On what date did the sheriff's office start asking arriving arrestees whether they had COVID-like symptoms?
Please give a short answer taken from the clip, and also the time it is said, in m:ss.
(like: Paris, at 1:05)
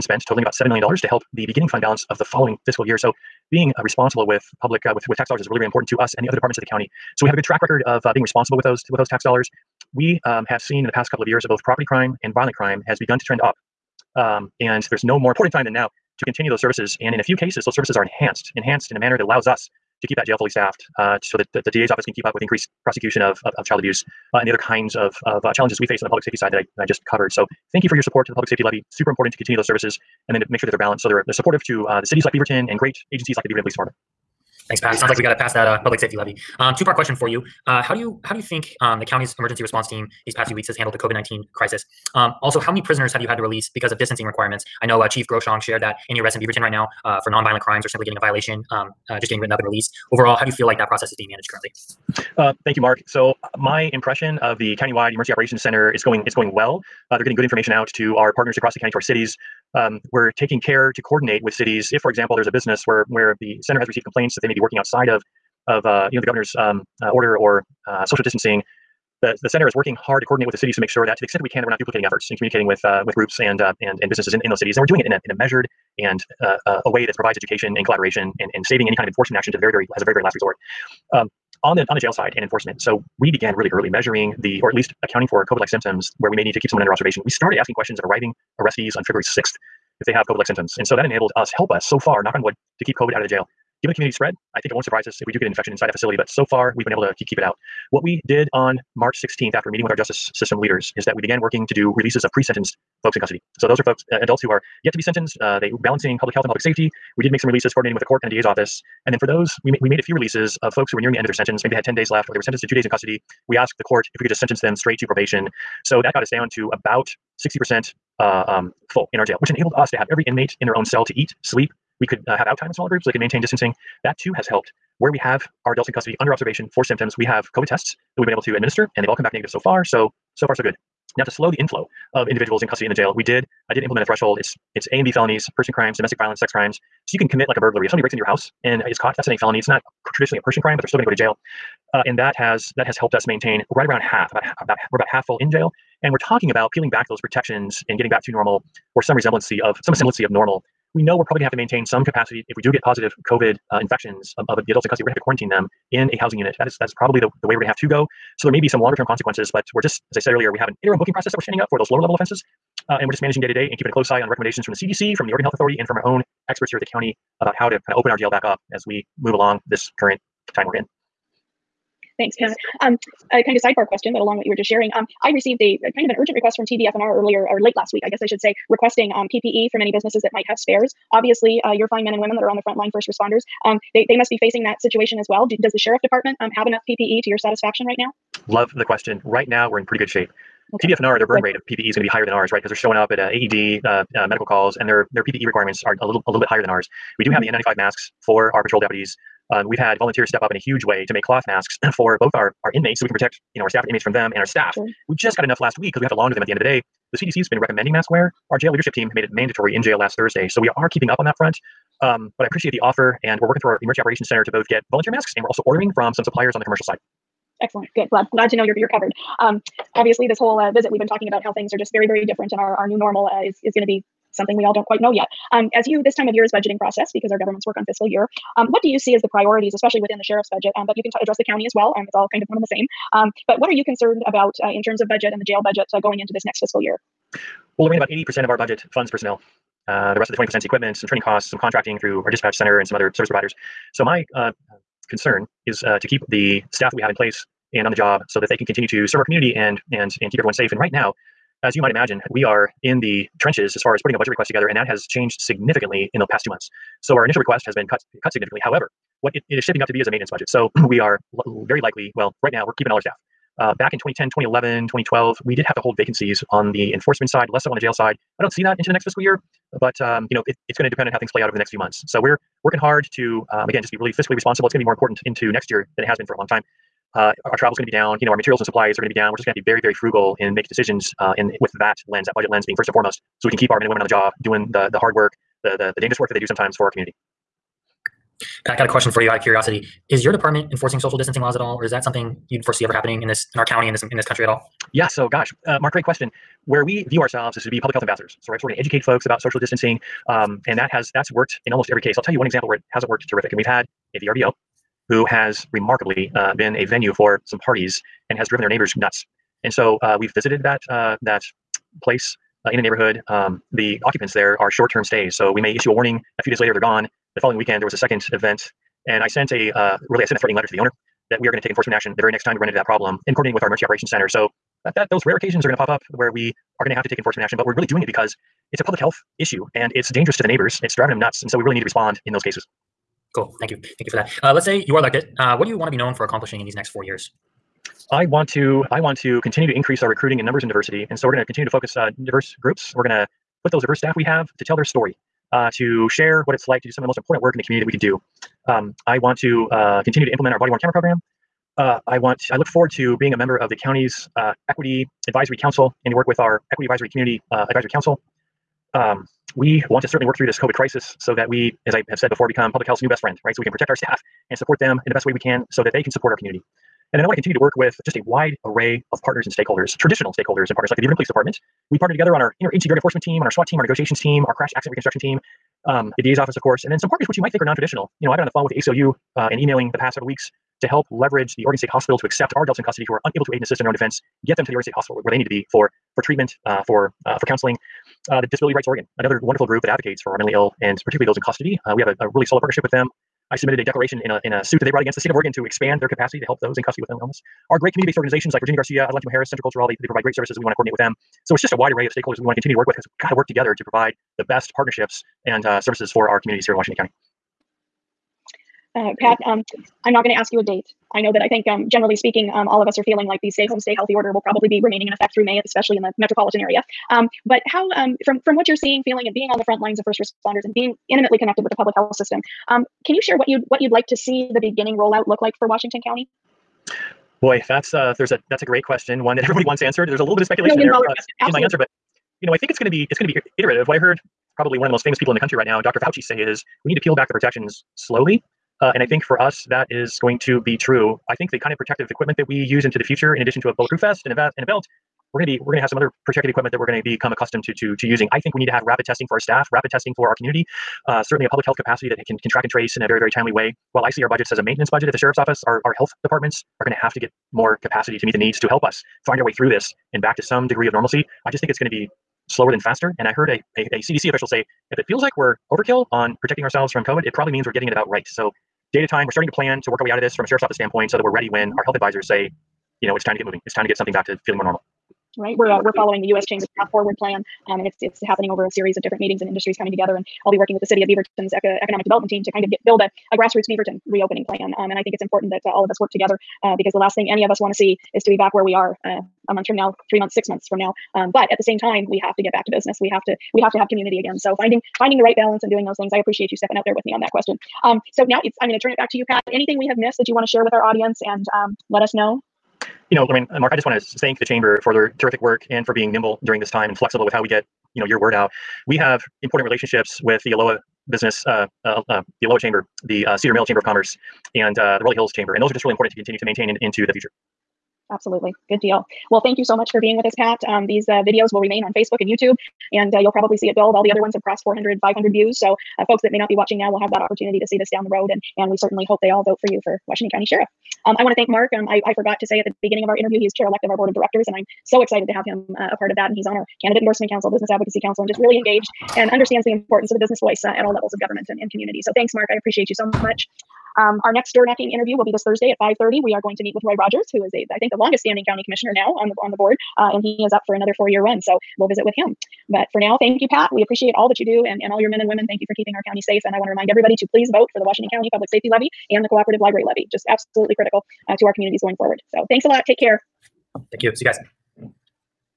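February 6, at 1:29.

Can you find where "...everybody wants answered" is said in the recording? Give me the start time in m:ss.
7:09.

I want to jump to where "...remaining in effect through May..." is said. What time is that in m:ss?
6:54.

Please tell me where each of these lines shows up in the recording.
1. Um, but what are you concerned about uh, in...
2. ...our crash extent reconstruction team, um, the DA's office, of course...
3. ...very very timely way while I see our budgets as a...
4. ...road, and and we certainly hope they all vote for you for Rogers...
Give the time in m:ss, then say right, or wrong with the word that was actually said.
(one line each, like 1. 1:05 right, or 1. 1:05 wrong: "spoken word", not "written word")
1. 3:53 right
2. 6:14 wrong: "accident", not "extent"
3. 7:33 right
4. 8:48 wrong: "Washington", not "Rogers".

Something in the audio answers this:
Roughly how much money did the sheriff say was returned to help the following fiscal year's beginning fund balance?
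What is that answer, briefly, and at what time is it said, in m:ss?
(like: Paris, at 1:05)
$7 million, at 0:00.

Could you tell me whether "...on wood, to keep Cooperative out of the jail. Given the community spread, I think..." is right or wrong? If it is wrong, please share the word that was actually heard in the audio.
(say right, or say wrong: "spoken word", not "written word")
wrong: "COVID", not "Cooperative".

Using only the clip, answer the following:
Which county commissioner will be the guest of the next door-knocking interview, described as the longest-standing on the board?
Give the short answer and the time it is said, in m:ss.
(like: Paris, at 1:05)
Roy Rogers, at 9:06.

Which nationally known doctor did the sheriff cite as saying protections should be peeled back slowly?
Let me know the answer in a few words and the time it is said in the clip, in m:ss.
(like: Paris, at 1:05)
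Dr. Fauci, at 7:15.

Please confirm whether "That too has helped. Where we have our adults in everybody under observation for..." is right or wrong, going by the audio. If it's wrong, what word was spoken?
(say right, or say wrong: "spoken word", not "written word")
wrong: "custody", not "everybody".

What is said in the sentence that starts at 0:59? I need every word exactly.
Um, we're taking care to coordinate with cities.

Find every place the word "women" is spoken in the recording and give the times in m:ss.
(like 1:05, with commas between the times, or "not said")
3:02, 4:43, 9:15.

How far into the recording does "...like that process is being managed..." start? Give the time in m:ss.
0:50.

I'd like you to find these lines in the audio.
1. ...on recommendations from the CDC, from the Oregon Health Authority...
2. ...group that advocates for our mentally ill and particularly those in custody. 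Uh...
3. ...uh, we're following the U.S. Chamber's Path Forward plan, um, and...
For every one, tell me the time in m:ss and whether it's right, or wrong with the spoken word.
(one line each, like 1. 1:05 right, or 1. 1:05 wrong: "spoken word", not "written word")
1. 2:44 right
2. 6:29 right
3. 7:55 right.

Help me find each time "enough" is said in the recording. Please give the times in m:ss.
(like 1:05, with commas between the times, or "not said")
3:06, 3:25.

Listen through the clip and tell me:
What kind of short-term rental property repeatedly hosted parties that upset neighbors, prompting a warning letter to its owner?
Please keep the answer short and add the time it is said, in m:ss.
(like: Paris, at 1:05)
VRBO, at 5:04.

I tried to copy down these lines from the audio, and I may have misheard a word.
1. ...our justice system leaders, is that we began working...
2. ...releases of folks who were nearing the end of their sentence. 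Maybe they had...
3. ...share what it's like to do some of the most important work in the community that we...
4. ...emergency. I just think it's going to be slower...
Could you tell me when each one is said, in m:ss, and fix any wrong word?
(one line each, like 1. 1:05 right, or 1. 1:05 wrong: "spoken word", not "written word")
1. 1:39 right
2. 1:50 right
3. 5:46 right
4. 7:40 wrong: "normalcy", not "emergency".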